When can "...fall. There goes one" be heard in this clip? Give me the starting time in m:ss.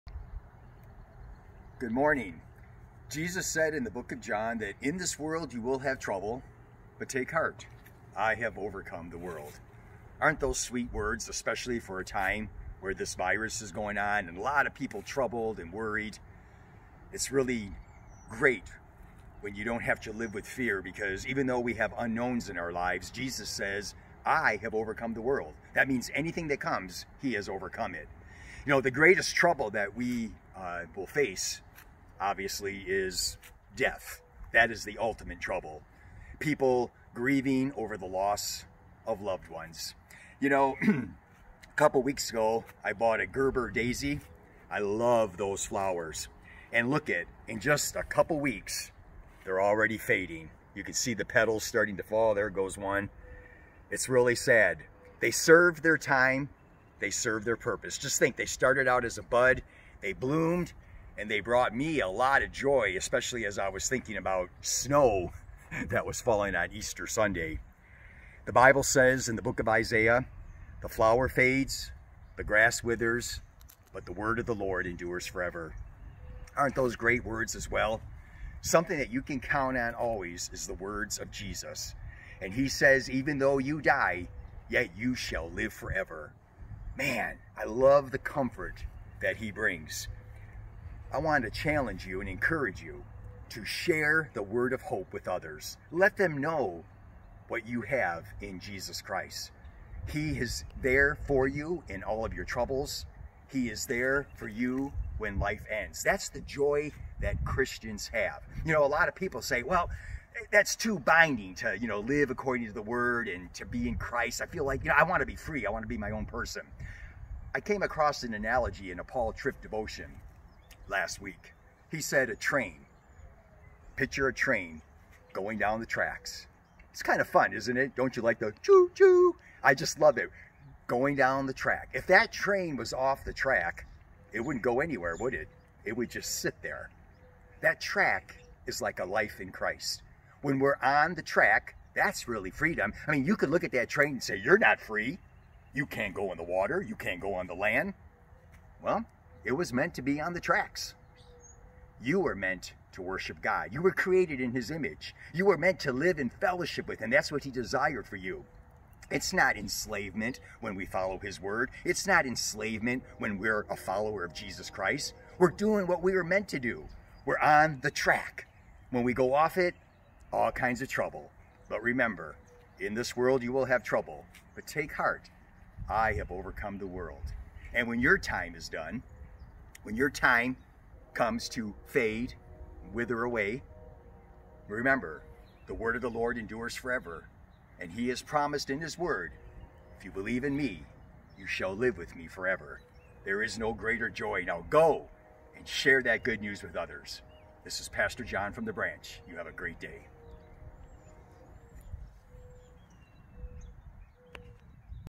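0:52.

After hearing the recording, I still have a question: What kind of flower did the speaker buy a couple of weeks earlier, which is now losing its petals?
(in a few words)
Gerber daisy.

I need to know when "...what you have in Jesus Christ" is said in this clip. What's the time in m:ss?
1:37.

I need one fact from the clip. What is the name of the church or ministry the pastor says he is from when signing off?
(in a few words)
The Branch.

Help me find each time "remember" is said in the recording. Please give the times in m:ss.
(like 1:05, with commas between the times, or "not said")
2:51, 3:04.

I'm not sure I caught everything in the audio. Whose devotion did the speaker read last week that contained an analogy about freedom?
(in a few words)
Paul Tripp.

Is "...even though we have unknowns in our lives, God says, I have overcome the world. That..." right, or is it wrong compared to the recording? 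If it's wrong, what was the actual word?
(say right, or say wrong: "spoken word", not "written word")
wrong: "Jesus", not "God".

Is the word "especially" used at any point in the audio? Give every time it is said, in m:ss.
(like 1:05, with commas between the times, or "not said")
0:11, 1:02.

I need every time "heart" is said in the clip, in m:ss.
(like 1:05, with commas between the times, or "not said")
0:07, 2:54.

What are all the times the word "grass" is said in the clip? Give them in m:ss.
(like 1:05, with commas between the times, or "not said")
1:12.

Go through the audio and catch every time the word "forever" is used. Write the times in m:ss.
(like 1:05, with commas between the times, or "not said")
1:15, 1:25, 3:06, 3:12.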